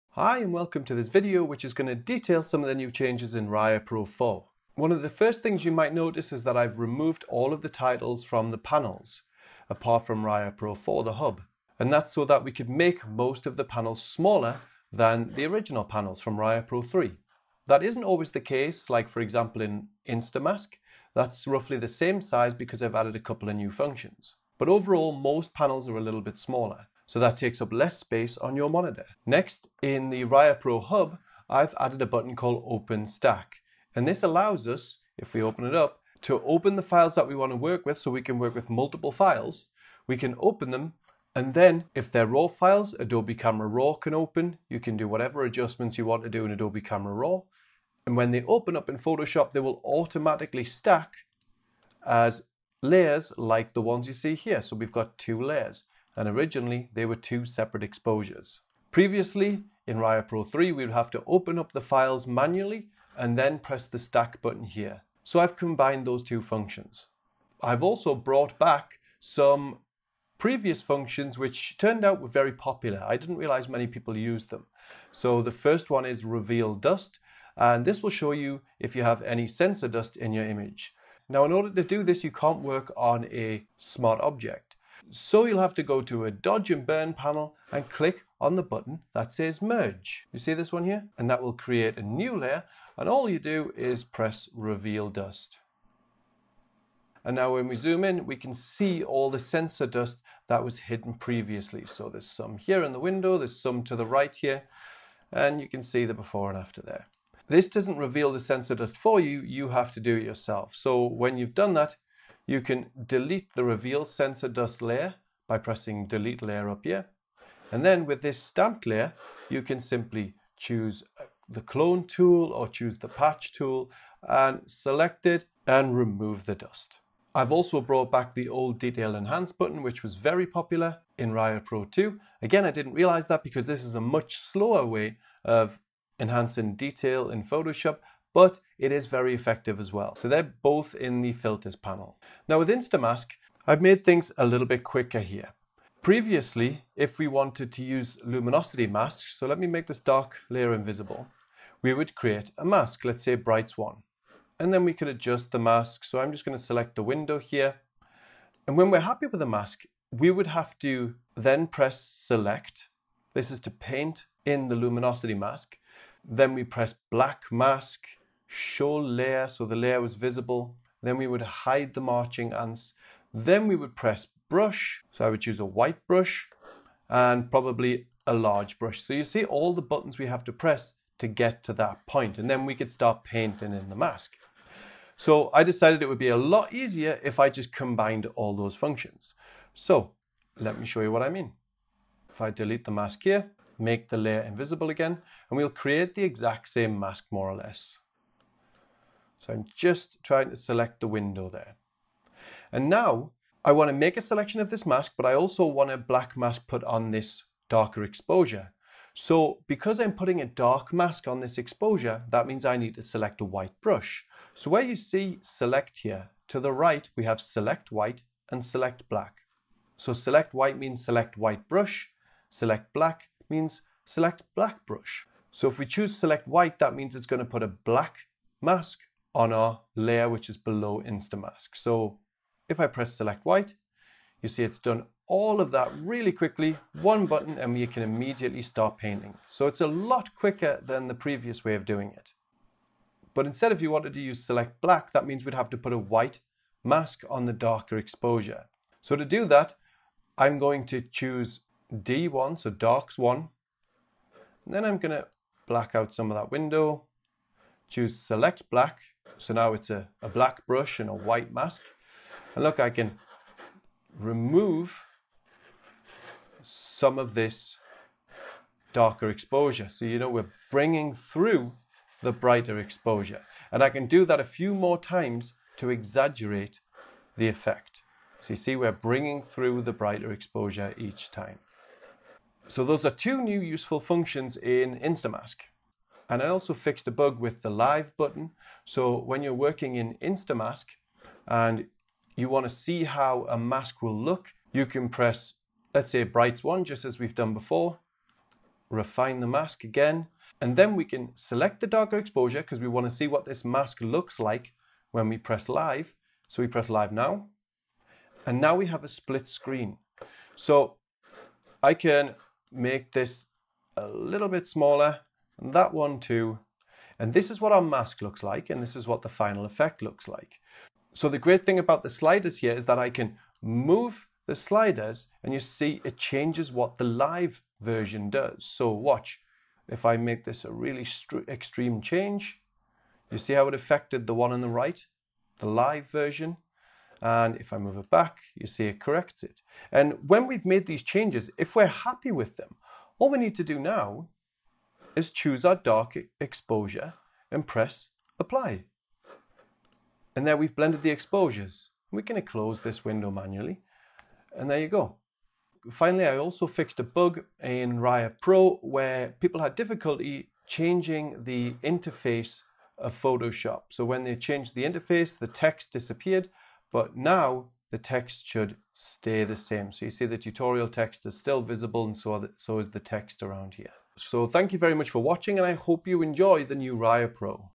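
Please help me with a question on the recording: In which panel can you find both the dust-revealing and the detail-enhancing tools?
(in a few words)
filters panel.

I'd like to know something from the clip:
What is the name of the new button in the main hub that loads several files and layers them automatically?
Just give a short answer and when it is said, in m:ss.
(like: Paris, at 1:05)
Open Stack, at 0:32.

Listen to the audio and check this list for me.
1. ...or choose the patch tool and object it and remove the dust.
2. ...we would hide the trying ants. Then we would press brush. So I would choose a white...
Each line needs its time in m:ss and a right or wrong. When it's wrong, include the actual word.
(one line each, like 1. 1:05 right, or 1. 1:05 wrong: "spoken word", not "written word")
1. 2:02 wrong: "select", not "object"
2. 2:51 wrong: "marching", not "trying".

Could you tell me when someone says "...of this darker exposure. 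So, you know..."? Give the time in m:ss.
4:27.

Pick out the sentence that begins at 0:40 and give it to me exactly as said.
We can open them and then if they're RAW files, Adobe Camera Raw can open.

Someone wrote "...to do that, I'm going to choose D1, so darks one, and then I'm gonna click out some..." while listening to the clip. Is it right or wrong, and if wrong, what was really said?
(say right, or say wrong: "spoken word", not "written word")
wrong: "black", not "click".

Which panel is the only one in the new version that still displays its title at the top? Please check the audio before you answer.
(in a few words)
the hub.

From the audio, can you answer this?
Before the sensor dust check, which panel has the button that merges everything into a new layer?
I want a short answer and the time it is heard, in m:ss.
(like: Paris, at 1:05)
dodge and burn panel, at 1:26.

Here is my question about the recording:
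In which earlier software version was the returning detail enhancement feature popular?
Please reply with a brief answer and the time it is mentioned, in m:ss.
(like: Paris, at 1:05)
Raya Pro 2, at 2:11.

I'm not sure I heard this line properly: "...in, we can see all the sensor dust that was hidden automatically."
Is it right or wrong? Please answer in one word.
wrong.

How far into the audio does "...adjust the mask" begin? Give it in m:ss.
2:35.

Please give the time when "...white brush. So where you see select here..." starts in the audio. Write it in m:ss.
3:33.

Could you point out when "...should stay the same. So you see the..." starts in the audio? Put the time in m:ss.
6:08.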